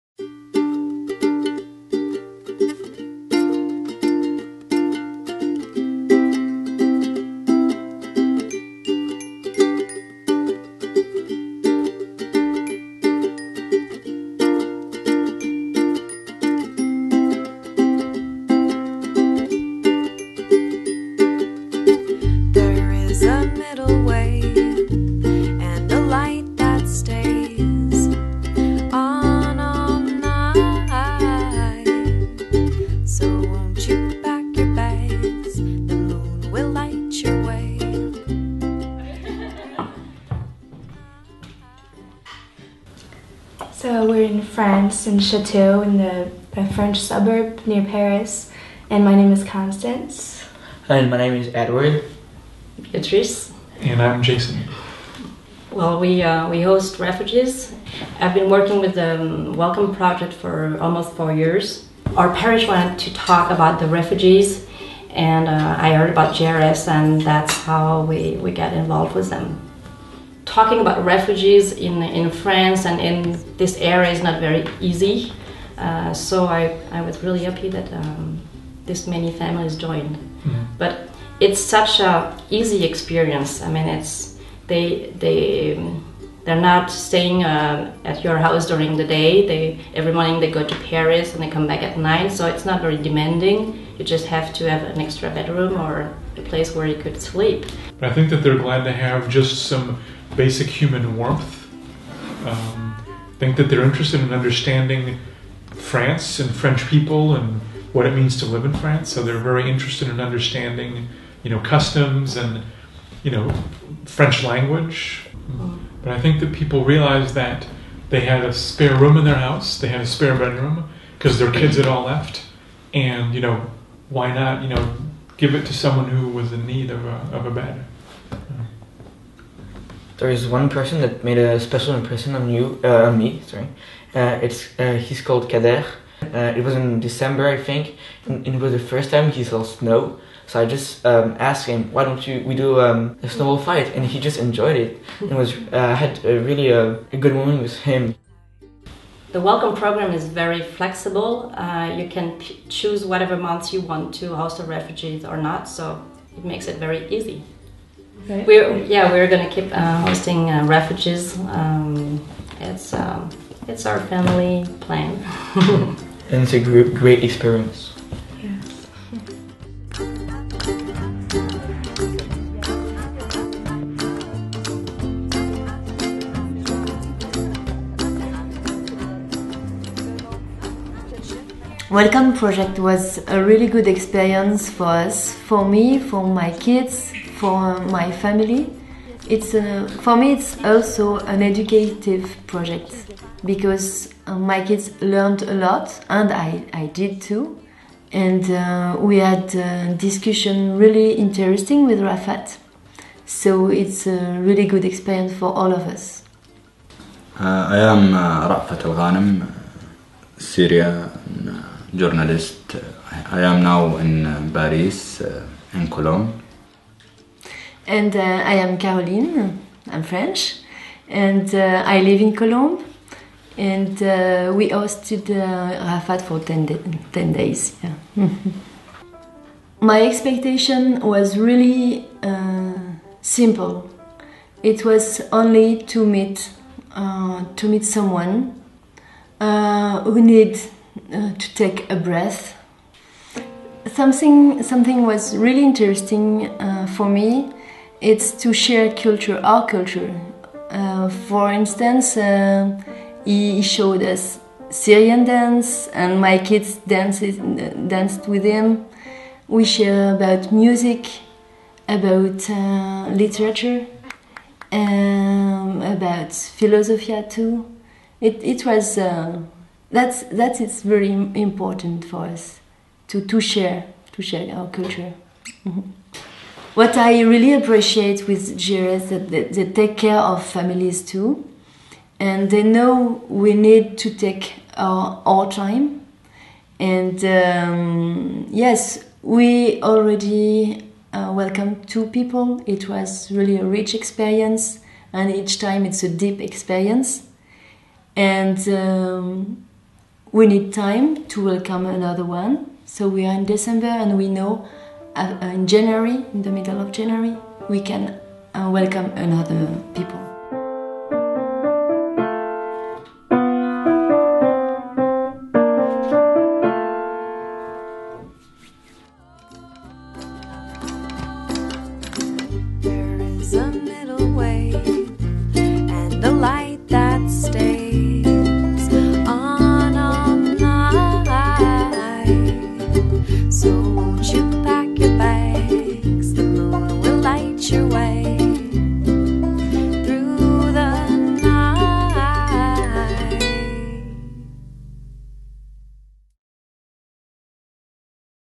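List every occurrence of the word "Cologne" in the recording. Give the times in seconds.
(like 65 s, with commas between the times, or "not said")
215 s, 222 s.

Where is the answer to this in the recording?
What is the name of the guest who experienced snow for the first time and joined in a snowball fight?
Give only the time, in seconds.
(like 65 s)
135 s.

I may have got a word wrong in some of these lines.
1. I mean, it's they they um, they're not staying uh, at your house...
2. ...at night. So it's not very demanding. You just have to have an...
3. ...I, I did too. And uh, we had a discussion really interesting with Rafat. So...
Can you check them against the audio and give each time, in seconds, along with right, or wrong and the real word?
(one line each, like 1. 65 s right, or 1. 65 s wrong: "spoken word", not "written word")
1. 83 s right
2. 91 s right
3. 196 s right.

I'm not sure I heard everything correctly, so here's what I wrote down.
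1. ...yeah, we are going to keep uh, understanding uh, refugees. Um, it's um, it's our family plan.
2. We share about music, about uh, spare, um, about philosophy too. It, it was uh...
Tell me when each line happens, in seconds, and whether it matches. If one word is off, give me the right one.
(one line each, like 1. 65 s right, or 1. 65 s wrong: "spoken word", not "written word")
1. 158 s wrong: "hosting", not "understanding"
2. 259 s wrong: "literature", not "spare".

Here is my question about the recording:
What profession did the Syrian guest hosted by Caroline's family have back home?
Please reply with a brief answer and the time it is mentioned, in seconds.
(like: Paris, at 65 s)
journalist, at 211 s.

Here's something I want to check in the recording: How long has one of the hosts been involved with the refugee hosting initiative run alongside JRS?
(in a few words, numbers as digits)
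almost four years.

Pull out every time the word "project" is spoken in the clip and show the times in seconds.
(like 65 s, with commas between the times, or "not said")
59 s, 182 s, 192 s.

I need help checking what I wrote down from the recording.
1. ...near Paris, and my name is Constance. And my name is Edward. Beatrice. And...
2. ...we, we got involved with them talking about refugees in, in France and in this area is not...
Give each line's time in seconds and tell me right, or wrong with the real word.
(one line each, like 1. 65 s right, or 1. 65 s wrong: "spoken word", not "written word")
1. 47 s right
2. 68 s right.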